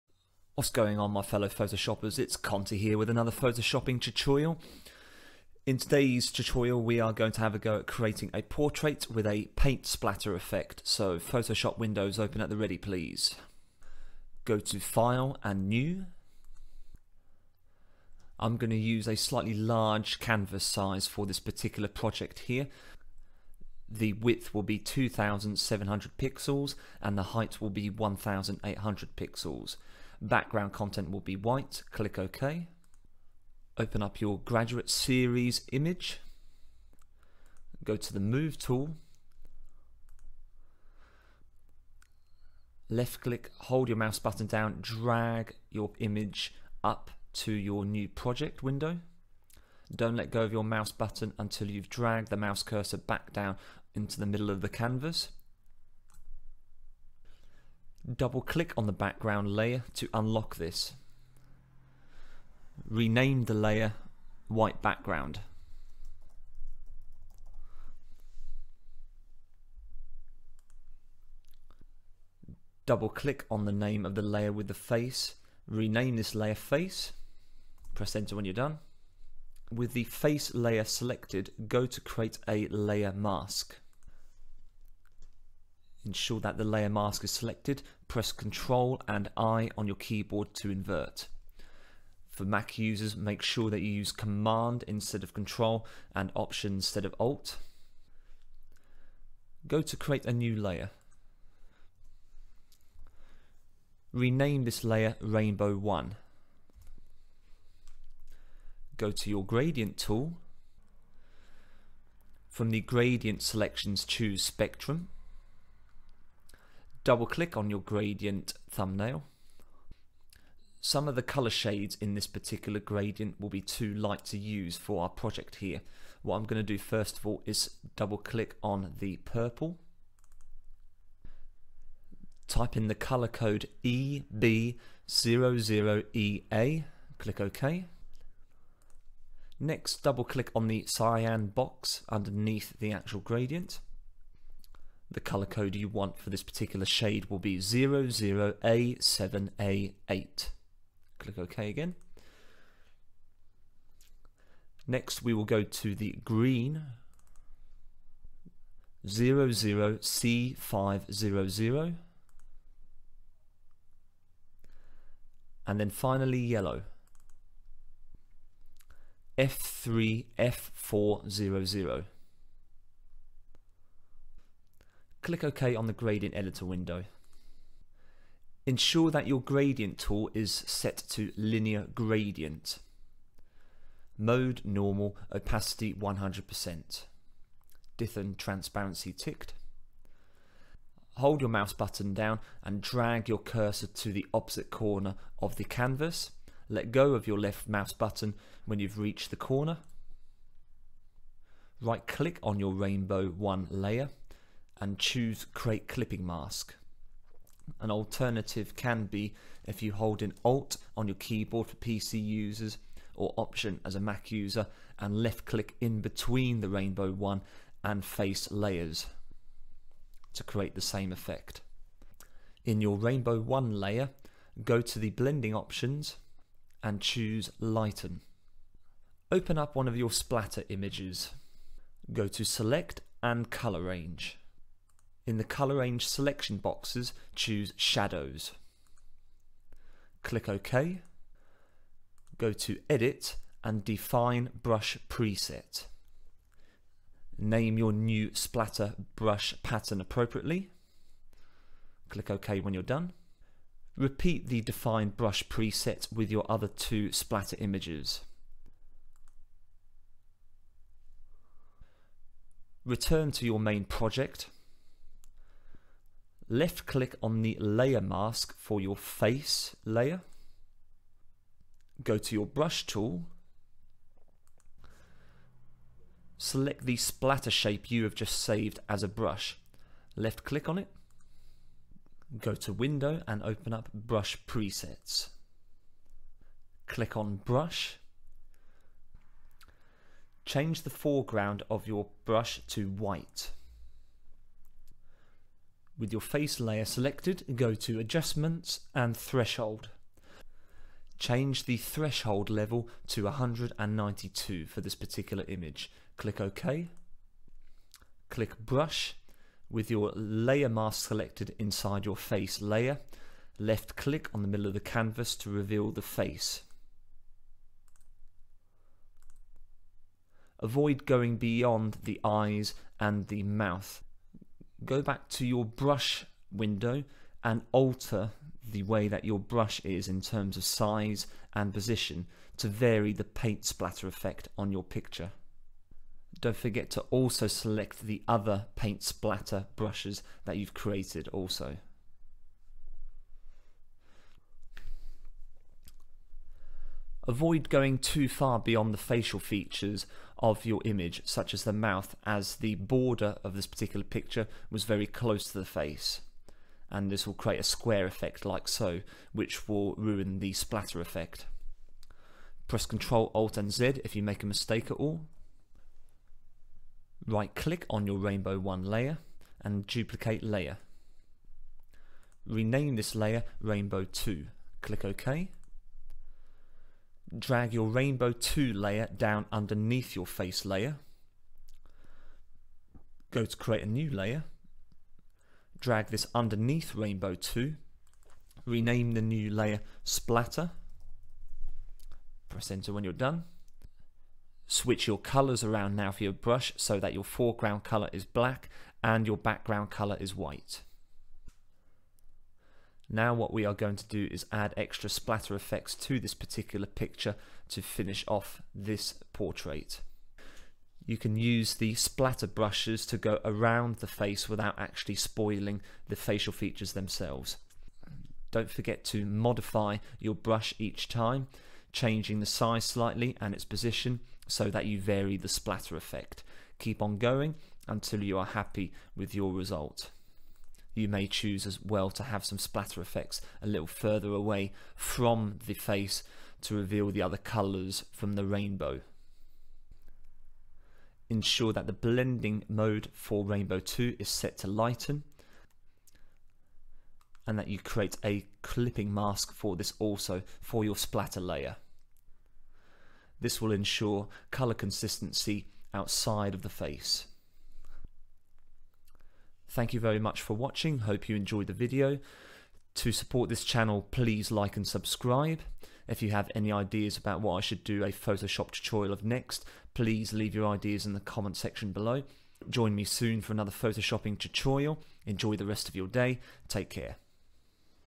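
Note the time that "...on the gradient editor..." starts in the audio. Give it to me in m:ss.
2:55.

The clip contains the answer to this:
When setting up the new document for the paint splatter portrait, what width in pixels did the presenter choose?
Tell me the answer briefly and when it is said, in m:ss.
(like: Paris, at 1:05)
2700 pixels, at 0:24.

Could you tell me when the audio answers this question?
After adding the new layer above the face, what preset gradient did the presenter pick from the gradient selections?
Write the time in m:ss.
1:54.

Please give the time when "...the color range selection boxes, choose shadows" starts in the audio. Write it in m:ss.
3:55.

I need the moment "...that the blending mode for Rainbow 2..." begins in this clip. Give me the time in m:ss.
7:21.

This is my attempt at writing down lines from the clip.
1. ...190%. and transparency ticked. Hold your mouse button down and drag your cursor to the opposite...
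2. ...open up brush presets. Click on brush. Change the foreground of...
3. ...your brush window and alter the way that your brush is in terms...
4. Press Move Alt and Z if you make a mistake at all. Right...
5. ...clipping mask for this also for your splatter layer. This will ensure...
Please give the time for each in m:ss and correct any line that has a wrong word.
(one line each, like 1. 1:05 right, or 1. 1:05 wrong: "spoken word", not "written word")
1. 3:05 wrong: "100", not "190"
2. 4:43 right
3. 5:25 right
4. 6:02 wrong: "Ctrl", not "Move"
5. 7:28 right.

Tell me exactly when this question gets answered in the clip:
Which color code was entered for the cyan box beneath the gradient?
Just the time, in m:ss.
2:27.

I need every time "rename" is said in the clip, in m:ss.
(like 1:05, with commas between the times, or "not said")
1:02, 1:15, 1:44, 6:12, 6:28.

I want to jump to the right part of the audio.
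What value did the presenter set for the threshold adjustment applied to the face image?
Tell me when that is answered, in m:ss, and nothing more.
5:03.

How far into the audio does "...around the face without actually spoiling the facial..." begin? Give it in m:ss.
6:53.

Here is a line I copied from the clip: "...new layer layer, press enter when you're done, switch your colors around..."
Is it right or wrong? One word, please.
wrong.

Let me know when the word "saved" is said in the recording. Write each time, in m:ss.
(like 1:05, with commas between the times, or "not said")
4:38.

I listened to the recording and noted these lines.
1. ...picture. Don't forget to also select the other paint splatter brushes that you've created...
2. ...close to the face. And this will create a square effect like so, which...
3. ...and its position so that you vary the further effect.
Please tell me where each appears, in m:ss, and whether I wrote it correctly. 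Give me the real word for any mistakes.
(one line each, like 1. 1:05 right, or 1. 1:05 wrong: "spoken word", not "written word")
1. 5:34 right
2. 5:55 right
3. 7:03 wrong: "splatter", not "further".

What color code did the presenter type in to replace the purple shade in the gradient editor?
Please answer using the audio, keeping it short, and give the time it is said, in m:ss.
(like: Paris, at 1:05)
EB00EA, at 2:13.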